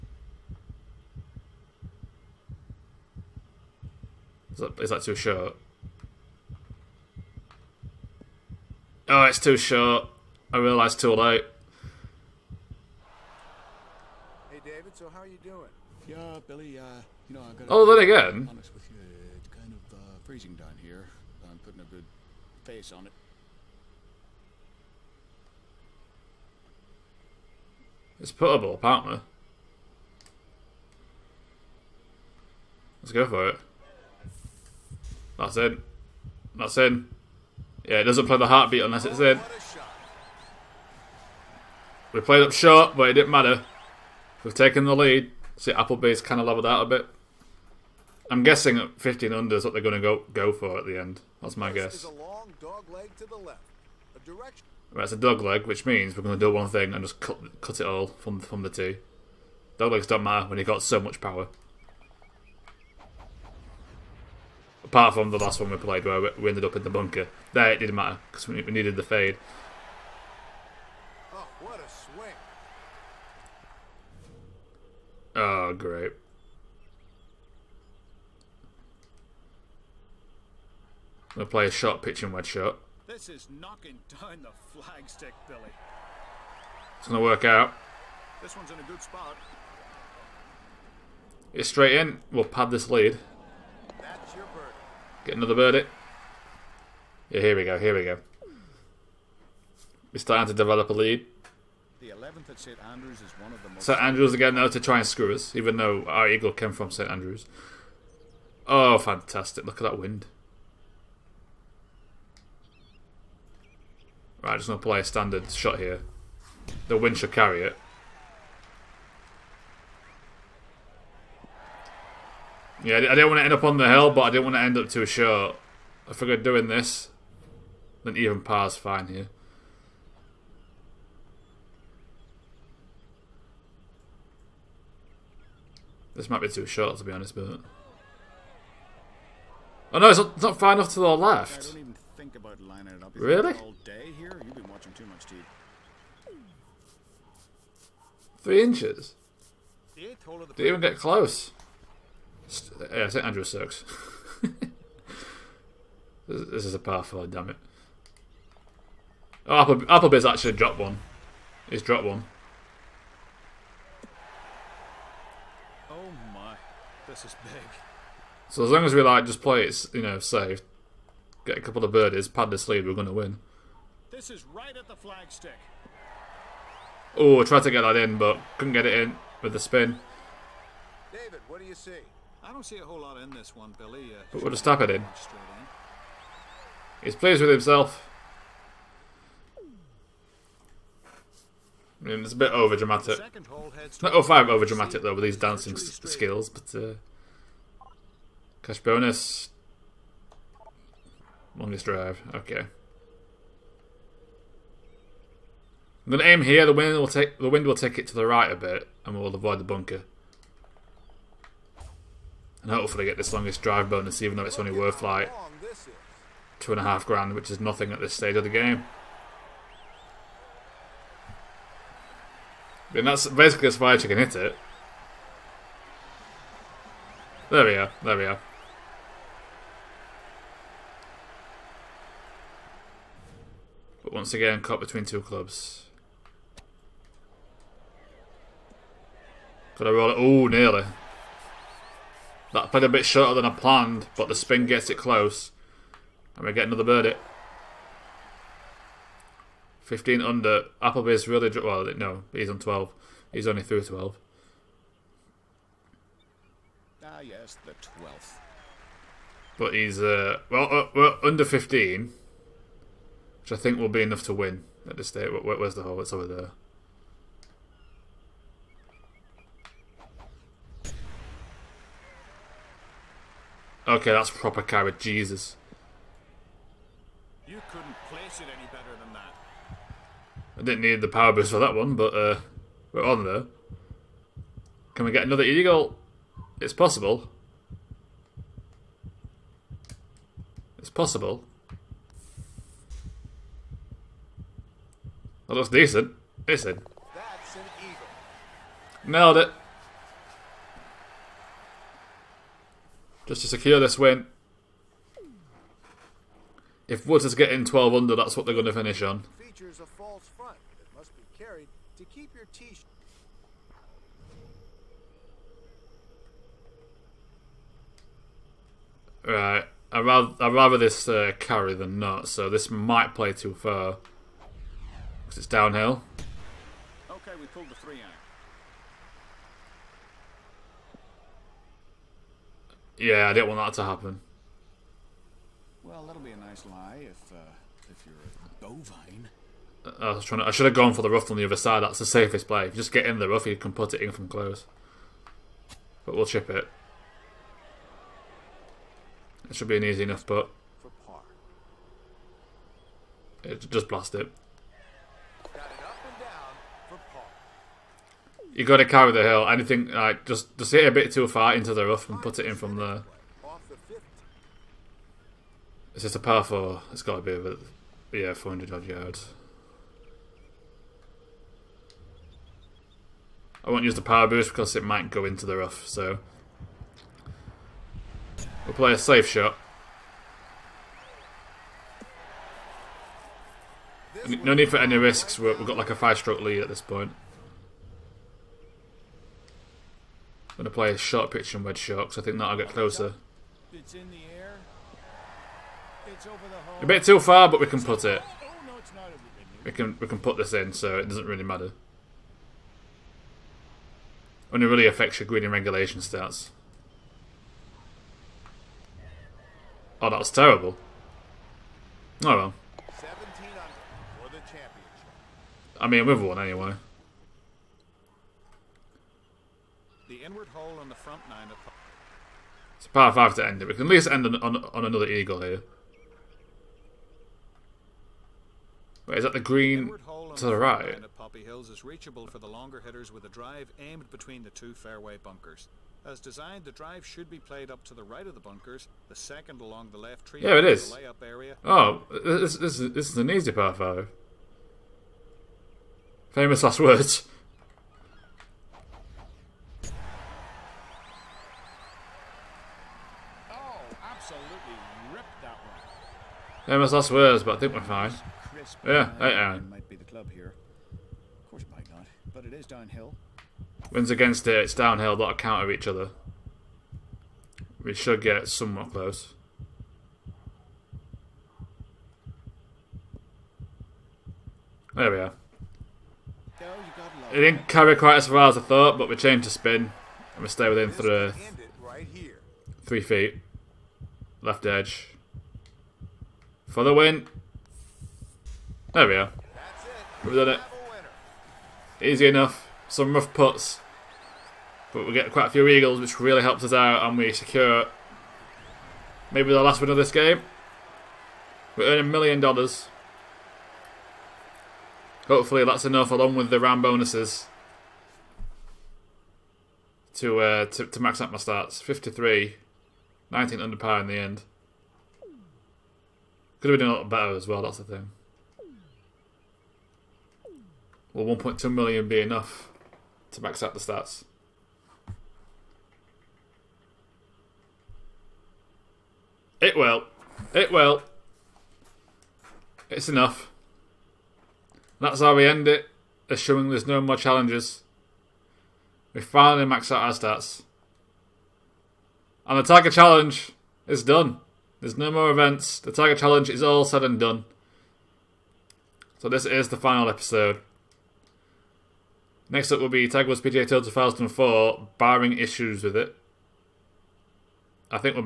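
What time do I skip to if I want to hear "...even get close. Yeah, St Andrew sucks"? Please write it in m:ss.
2:30.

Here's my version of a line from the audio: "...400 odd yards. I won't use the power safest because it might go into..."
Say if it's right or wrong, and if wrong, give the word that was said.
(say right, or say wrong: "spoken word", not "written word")
wrong: "boost", not "safest".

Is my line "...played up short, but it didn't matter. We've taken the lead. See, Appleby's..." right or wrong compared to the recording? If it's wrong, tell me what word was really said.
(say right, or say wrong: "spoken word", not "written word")
right.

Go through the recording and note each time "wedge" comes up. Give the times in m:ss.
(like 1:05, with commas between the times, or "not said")
1:22, 6:31.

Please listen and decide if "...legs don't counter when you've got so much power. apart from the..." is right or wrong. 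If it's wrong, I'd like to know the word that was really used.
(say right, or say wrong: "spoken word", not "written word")
wrong: "matter", not "counter".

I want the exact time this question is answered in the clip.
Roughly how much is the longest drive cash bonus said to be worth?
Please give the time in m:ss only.
3:36.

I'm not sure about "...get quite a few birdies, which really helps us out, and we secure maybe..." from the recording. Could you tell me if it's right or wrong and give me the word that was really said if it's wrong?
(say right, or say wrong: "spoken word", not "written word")
wrong: "eagles", not "birdies".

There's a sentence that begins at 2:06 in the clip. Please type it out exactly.
I figured doing this, then even par's fine here.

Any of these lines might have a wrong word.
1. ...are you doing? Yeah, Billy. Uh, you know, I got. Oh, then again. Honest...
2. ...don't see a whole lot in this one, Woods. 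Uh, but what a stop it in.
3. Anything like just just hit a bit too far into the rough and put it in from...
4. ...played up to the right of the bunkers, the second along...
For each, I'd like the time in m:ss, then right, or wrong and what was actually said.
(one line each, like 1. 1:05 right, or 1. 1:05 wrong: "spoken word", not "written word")
1. 0:15 right
2. 3:02 wrong: "Billy", not "Woods"
3. 5:59 right
4. 7:17 right.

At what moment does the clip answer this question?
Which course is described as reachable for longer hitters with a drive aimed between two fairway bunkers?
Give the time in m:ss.
7:11.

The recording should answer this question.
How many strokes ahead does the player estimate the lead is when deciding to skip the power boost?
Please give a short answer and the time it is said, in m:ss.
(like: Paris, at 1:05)
5, at 6:25.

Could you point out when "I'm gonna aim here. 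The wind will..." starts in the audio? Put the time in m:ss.
3:26.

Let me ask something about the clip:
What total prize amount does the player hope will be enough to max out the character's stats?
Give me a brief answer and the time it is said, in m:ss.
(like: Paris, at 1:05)
1.2 million, at 8:41.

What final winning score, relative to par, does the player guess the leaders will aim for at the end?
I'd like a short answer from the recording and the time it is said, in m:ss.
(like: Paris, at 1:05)
15 under, at 0:48.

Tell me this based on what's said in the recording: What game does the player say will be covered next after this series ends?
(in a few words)
Tiger Woods PGA Tour 2004.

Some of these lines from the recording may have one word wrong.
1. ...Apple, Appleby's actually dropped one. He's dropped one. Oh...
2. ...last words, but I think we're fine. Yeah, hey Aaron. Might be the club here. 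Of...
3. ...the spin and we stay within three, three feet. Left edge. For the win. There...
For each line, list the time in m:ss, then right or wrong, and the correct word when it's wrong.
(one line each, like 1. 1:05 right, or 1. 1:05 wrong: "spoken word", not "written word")
1. 2:39 right
2. 7:36 right
3. 7:59 right.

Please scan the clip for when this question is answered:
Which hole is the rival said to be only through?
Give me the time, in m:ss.
4:13.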